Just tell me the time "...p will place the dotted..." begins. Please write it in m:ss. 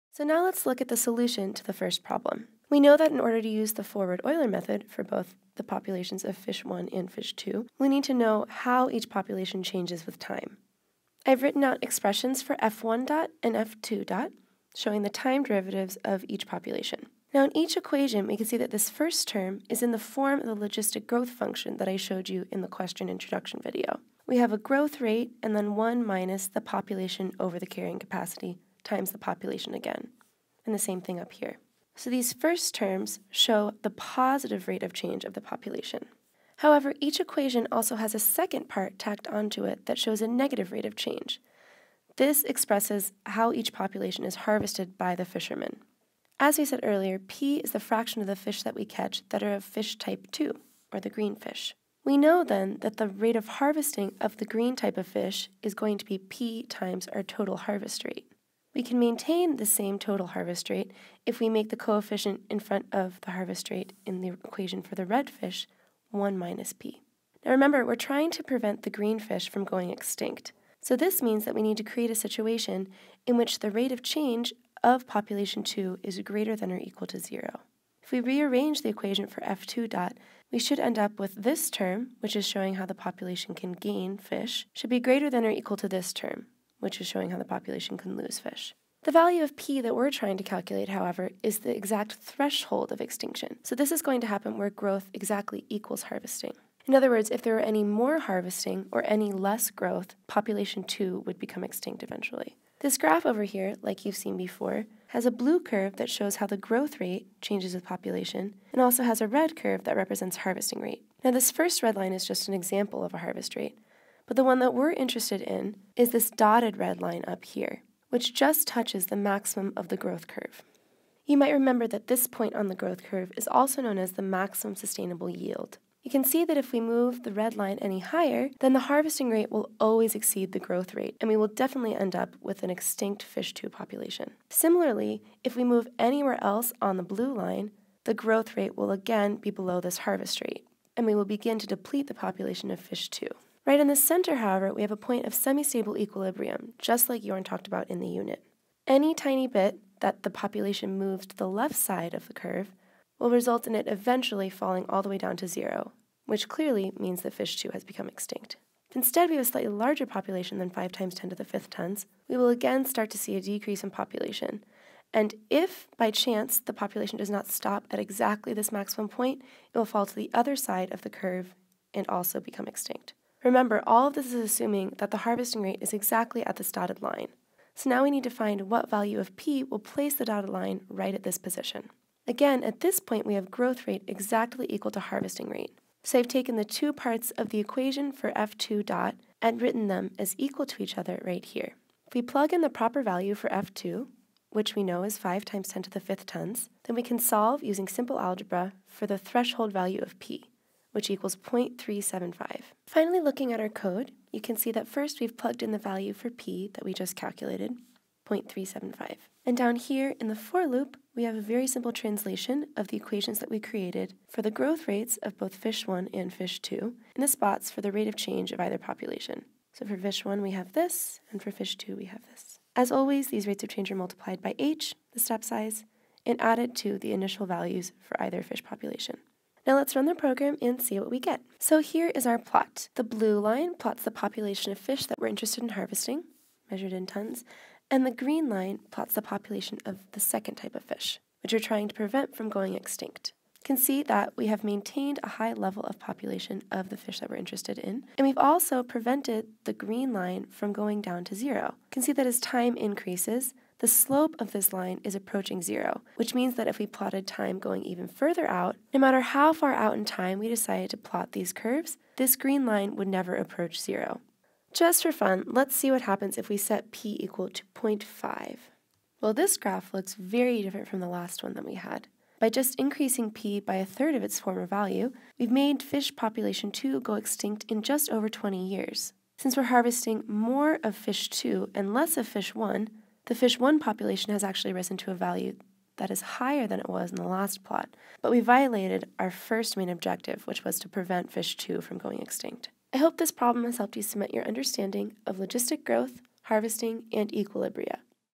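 2:59.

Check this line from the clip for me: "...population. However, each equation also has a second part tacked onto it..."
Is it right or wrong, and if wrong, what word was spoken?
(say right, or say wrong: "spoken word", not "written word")
right.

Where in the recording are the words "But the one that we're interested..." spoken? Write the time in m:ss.
1:54.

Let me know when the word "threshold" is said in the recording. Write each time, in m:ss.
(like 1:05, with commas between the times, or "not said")
1:32, 3:19.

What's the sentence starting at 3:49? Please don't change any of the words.
Now let's run the program and see what we get.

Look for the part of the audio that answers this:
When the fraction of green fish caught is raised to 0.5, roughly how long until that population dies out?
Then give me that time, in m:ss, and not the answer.
4:37.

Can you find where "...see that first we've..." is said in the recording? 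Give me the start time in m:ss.
3:24.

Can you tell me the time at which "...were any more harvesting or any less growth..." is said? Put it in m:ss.
1:37.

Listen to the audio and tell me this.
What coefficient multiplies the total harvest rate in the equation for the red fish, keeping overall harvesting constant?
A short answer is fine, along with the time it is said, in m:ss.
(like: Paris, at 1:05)
1 minus p, at 1:06.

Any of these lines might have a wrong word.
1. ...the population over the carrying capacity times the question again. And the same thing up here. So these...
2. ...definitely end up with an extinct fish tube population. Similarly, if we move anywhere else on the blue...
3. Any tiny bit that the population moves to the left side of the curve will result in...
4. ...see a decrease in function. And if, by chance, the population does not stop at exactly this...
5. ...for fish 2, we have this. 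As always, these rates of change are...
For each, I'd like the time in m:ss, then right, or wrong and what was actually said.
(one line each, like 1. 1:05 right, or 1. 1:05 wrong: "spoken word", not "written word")
1. 0:26 wrong: "population", not "question"
2. 2:11 right
3. 2:28 right
4. 2:43 wrong: "population", not "function"
5. 3:41 right.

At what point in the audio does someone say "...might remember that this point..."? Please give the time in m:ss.
2:01.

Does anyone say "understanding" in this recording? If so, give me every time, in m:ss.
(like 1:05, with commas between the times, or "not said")
4:54.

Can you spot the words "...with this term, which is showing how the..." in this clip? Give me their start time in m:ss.
1:21.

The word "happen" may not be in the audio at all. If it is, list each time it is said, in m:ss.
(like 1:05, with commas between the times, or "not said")
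1:34, 4:26.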